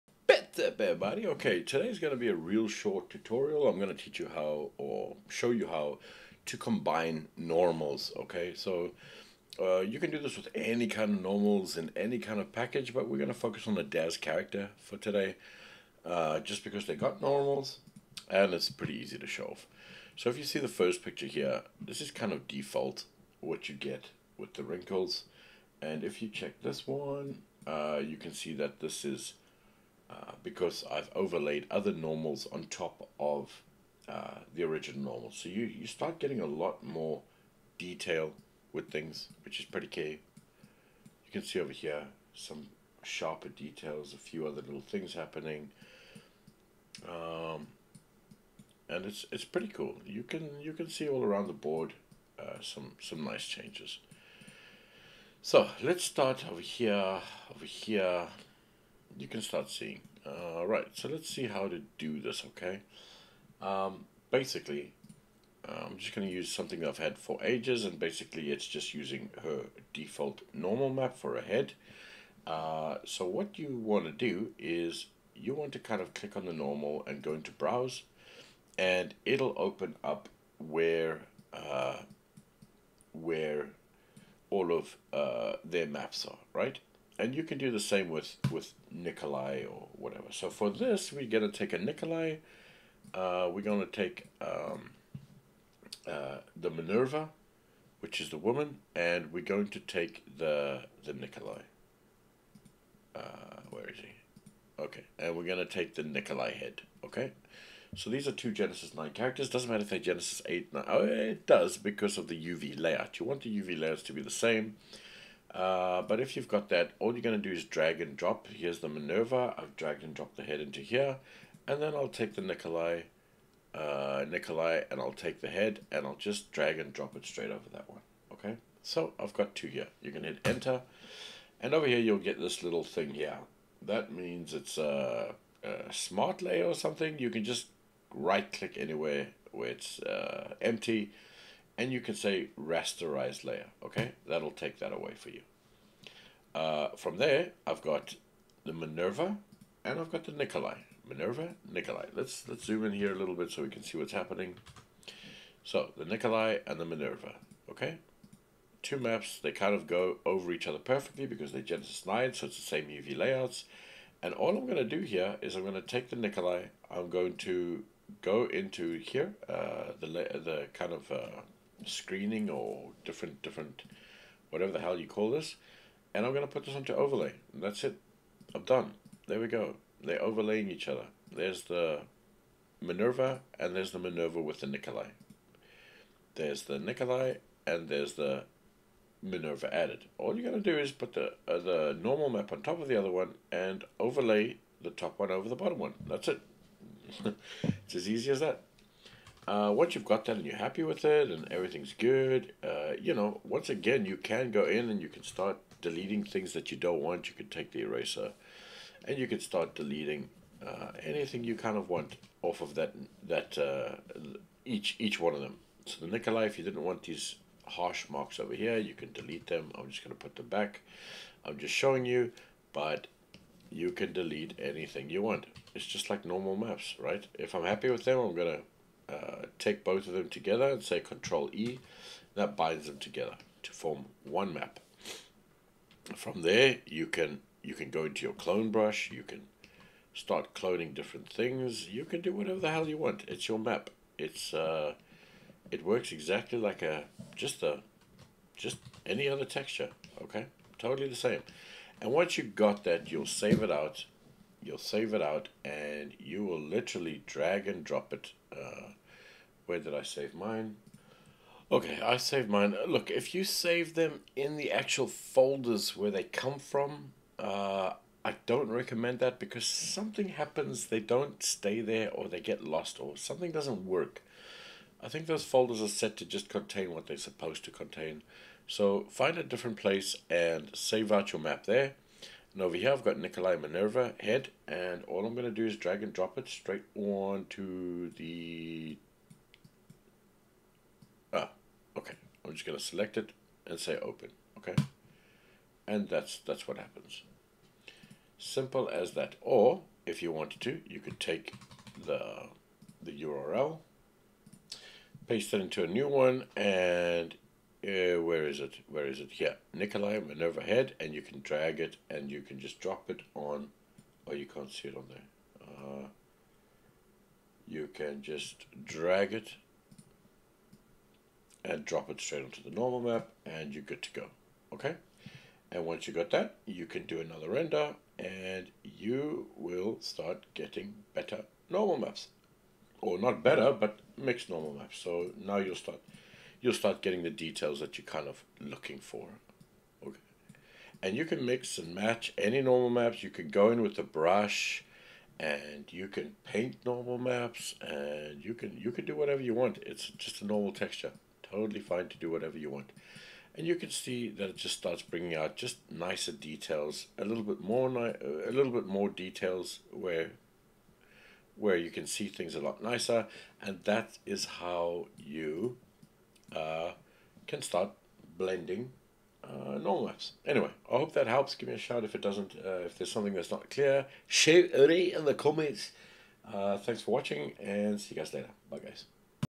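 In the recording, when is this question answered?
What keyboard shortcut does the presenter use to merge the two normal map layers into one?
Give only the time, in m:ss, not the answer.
3:51.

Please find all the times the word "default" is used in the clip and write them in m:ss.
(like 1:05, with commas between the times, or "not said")
0:22, 1:09.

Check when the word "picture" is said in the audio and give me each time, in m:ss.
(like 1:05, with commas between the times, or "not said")
0:21.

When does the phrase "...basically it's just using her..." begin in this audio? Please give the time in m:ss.
1:07.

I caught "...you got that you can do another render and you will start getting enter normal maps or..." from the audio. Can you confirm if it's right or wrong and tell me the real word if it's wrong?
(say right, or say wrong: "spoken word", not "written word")
wrong: "better", not "enter".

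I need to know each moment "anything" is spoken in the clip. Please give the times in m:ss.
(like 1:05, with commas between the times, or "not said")
3:31, 3:44.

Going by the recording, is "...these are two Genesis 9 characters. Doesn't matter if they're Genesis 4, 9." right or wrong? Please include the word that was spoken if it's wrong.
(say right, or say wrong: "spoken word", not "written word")
wrong: "8", not "4".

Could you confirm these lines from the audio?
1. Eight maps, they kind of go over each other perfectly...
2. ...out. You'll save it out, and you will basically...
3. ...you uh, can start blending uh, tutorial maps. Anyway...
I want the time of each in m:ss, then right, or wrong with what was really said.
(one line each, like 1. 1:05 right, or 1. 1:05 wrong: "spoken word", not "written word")
1. 2:38 wrong: "Two", not "Eight"
2. 4:13 wrong: "literally", not "basically"
3. 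6:05 wrong: "normal", not "tutorial".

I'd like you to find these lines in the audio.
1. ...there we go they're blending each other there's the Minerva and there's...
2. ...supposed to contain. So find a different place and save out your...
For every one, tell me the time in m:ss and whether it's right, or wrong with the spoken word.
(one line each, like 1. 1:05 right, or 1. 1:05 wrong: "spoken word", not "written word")
1. 2:59 wrong: "overlaying", not "blending"
2. 4:37 right.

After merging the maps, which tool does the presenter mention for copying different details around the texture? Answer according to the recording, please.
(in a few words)
clone brush.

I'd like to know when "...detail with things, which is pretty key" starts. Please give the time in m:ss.
0:37.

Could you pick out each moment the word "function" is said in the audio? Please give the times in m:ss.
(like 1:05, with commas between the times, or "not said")
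not said.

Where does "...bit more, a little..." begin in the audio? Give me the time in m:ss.
5:57.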